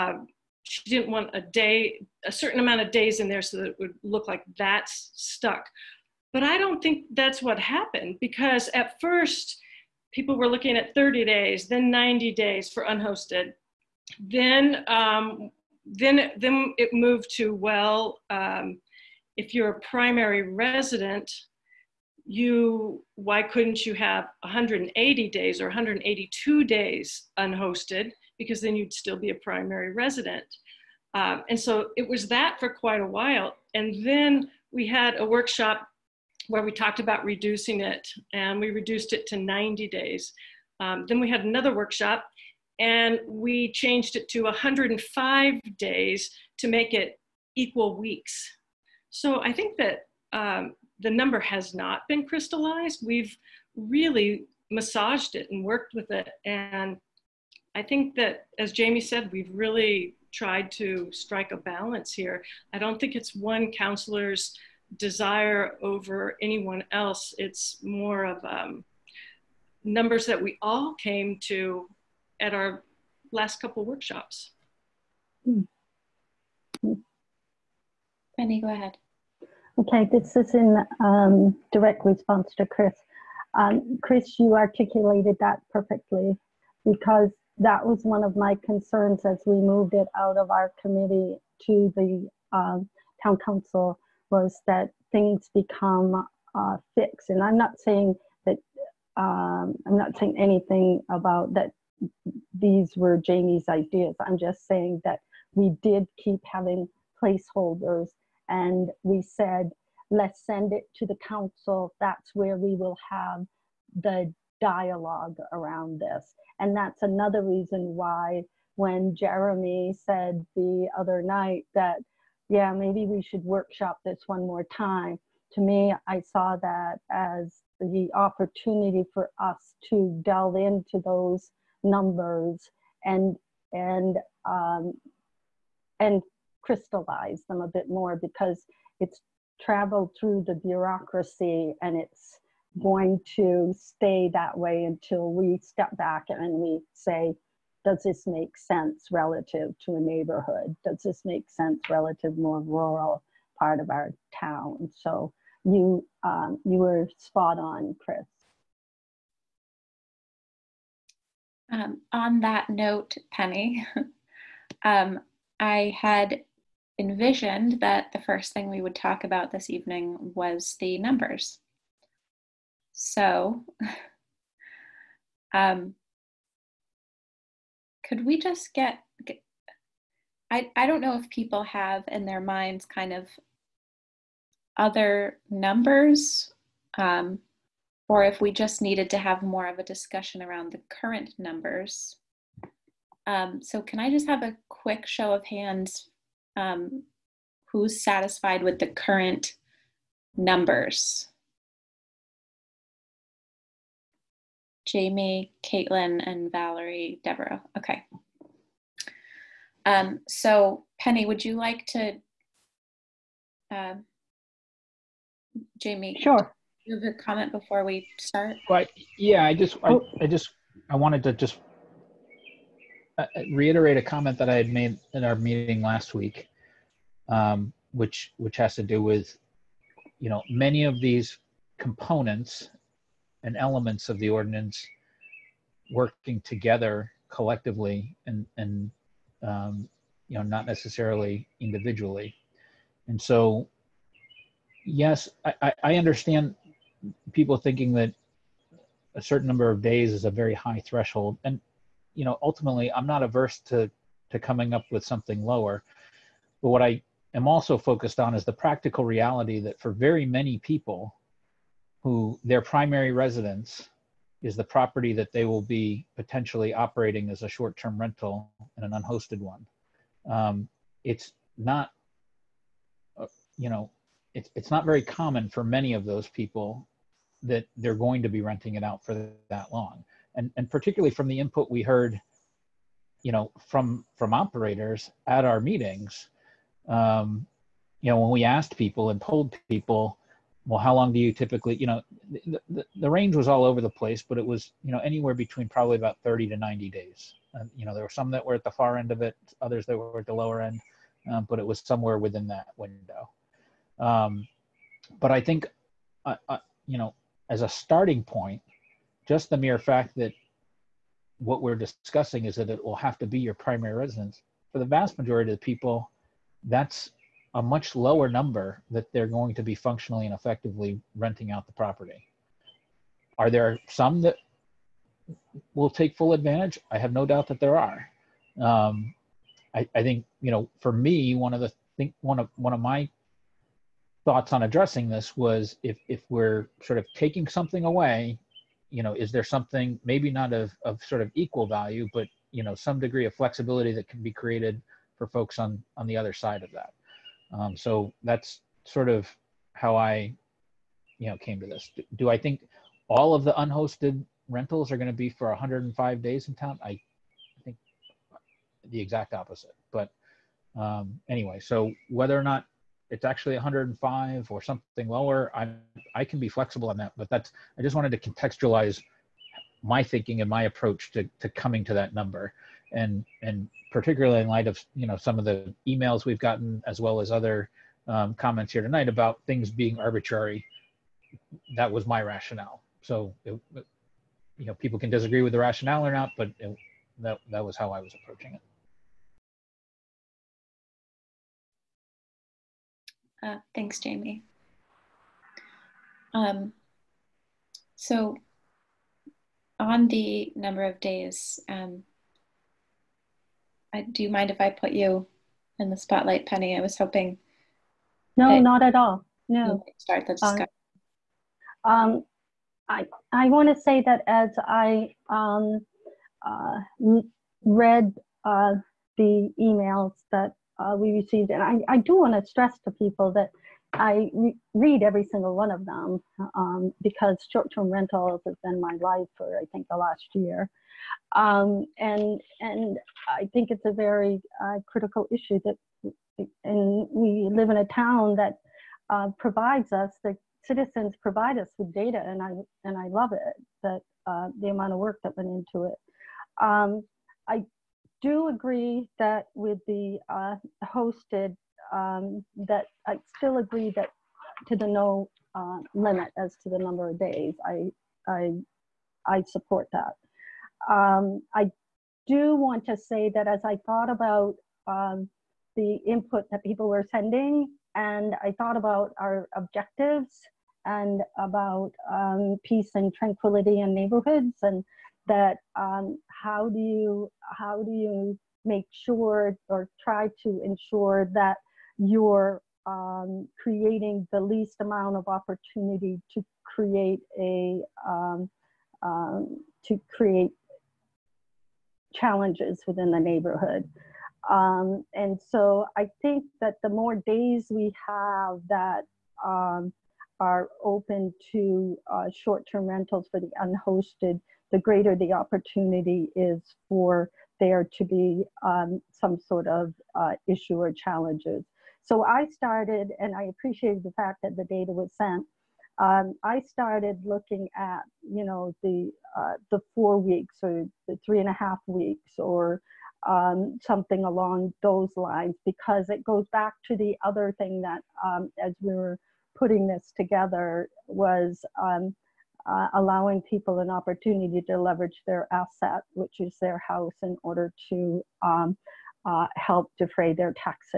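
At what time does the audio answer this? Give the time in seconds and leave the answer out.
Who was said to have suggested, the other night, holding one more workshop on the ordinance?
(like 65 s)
119 s.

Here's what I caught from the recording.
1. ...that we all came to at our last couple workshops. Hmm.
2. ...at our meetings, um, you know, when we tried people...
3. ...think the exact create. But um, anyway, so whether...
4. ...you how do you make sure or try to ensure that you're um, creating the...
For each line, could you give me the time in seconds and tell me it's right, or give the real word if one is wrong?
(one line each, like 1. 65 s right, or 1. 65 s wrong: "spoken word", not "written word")
1. 70 s right
2. 285 s wrong: "asked", not "tried"
3. 357 s wrong: "opposite", not "create"
4. 476 s right.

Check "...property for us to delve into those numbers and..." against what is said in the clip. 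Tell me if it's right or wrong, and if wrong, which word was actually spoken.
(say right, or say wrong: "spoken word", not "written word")
wrong: "opportunity", not "property".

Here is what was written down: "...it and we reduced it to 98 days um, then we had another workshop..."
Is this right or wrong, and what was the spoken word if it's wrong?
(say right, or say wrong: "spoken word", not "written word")
wrong: "90", not "98".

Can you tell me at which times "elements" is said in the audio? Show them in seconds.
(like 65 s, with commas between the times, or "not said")
233 s.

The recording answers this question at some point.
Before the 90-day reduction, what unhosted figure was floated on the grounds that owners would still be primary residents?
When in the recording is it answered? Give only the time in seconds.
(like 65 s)
25 s.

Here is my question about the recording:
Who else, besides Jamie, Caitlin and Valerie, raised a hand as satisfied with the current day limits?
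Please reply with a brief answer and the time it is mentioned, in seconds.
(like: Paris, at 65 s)
Deborah, at 207 s.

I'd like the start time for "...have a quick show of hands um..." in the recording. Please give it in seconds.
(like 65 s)
194 s.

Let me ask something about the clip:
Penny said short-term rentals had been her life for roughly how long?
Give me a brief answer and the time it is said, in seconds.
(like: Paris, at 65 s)
the last year, at 429 s.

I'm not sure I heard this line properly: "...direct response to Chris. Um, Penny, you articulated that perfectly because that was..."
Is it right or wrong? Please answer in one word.
wrong.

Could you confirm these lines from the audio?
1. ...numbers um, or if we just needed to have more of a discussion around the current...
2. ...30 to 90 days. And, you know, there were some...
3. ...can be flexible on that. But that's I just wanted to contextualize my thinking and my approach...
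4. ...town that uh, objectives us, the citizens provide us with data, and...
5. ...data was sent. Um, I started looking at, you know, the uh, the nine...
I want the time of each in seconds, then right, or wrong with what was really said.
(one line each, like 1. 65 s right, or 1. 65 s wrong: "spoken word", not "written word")
1. 185 s right
2. 296 s right
3. 366 s right
4. 437 s wrong: "provides", not "objectives"
5. 514 s wrong: "four", not "nine".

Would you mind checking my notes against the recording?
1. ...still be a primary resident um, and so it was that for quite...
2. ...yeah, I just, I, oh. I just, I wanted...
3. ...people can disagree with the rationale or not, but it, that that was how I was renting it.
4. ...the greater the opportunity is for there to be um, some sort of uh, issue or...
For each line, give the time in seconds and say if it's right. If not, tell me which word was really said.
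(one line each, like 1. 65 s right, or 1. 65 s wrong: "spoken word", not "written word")
1. 28 s right
2. 219 s right
3. 384 s wrong: "approaching", not "renting"
4. 504 s right.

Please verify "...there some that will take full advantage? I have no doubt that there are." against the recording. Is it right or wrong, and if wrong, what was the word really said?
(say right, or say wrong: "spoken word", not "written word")
right.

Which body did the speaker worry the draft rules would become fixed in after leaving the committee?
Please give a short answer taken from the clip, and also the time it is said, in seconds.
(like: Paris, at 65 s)
town council, at 93 s.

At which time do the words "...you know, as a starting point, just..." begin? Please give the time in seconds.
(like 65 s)
306 s.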